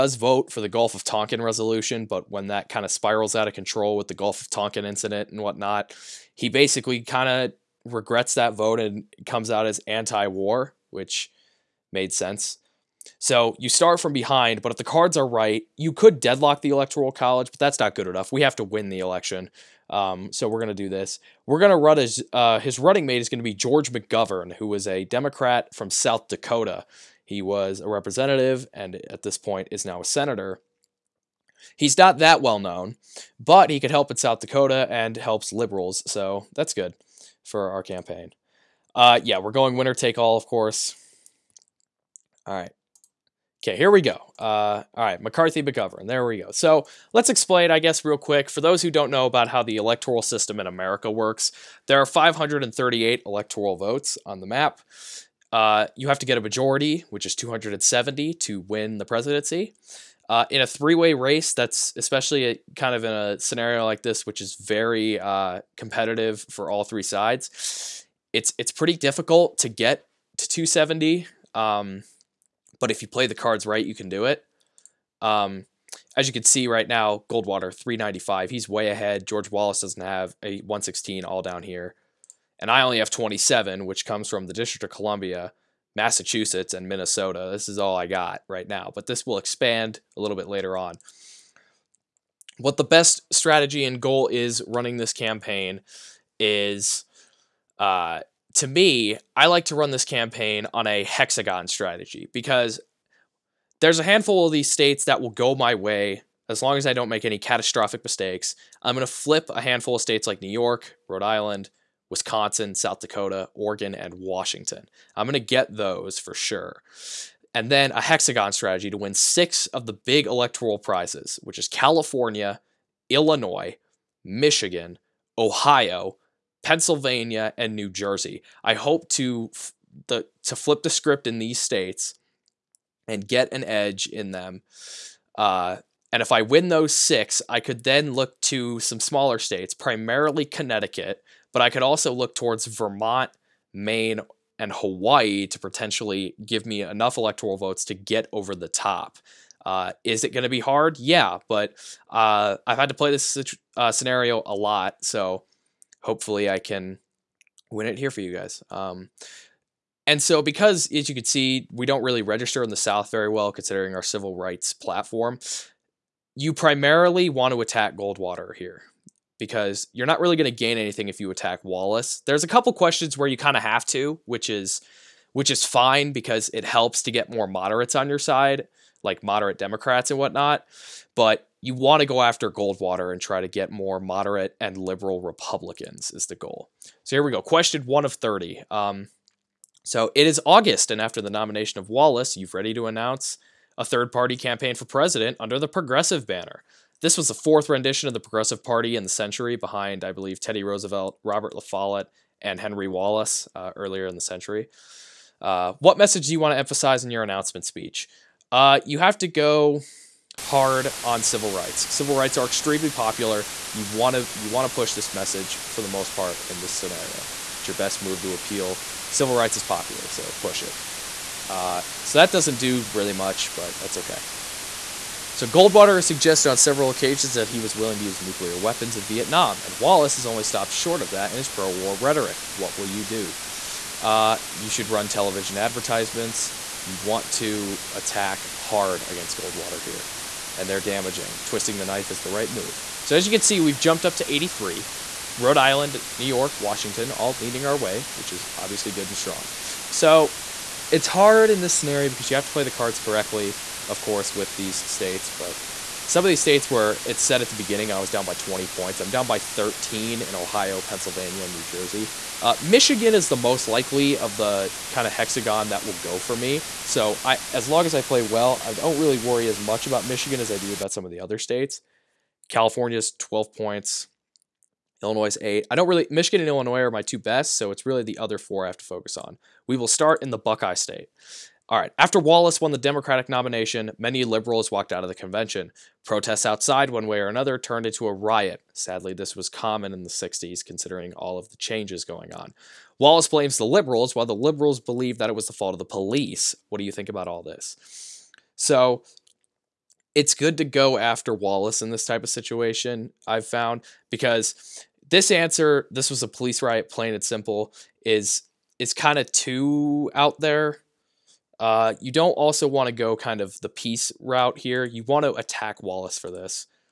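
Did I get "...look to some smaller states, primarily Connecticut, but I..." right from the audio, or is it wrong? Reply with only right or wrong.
right.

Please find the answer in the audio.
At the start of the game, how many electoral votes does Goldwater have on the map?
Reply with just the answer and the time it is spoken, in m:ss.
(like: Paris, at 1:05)
395, at 1:17.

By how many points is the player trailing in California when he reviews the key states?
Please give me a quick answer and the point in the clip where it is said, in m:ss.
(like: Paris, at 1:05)
12, at 4:33.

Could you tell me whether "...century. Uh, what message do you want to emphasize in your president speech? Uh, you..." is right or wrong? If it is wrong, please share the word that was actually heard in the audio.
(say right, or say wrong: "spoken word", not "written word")
wrong: "announcement", not "president".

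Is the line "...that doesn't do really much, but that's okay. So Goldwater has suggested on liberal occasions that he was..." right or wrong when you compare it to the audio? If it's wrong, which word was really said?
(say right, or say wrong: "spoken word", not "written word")
wrong: "several", not "liberal".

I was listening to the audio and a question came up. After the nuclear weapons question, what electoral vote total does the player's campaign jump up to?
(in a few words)
83.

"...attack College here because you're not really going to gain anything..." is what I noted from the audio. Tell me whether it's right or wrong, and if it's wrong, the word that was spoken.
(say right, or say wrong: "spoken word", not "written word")
wrong: "Goldwater", not "College".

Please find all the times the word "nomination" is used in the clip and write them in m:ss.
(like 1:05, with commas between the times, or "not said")
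3:11, 4:43.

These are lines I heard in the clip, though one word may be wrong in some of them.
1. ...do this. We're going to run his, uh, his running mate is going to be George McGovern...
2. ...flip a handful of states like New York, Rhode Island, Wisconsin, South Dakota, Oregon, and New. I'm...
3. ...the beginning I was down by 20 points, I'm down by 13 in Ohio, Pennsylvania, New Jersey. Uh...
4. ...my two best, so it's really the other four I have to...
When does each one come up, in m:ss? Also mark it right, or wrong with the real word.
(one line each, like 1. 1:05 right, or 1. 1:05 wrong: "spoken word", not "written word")
1. 0:20 right
2. 1:49 wrong: "Washington", not "New"
3. 4:17 right
4. 4:36 right.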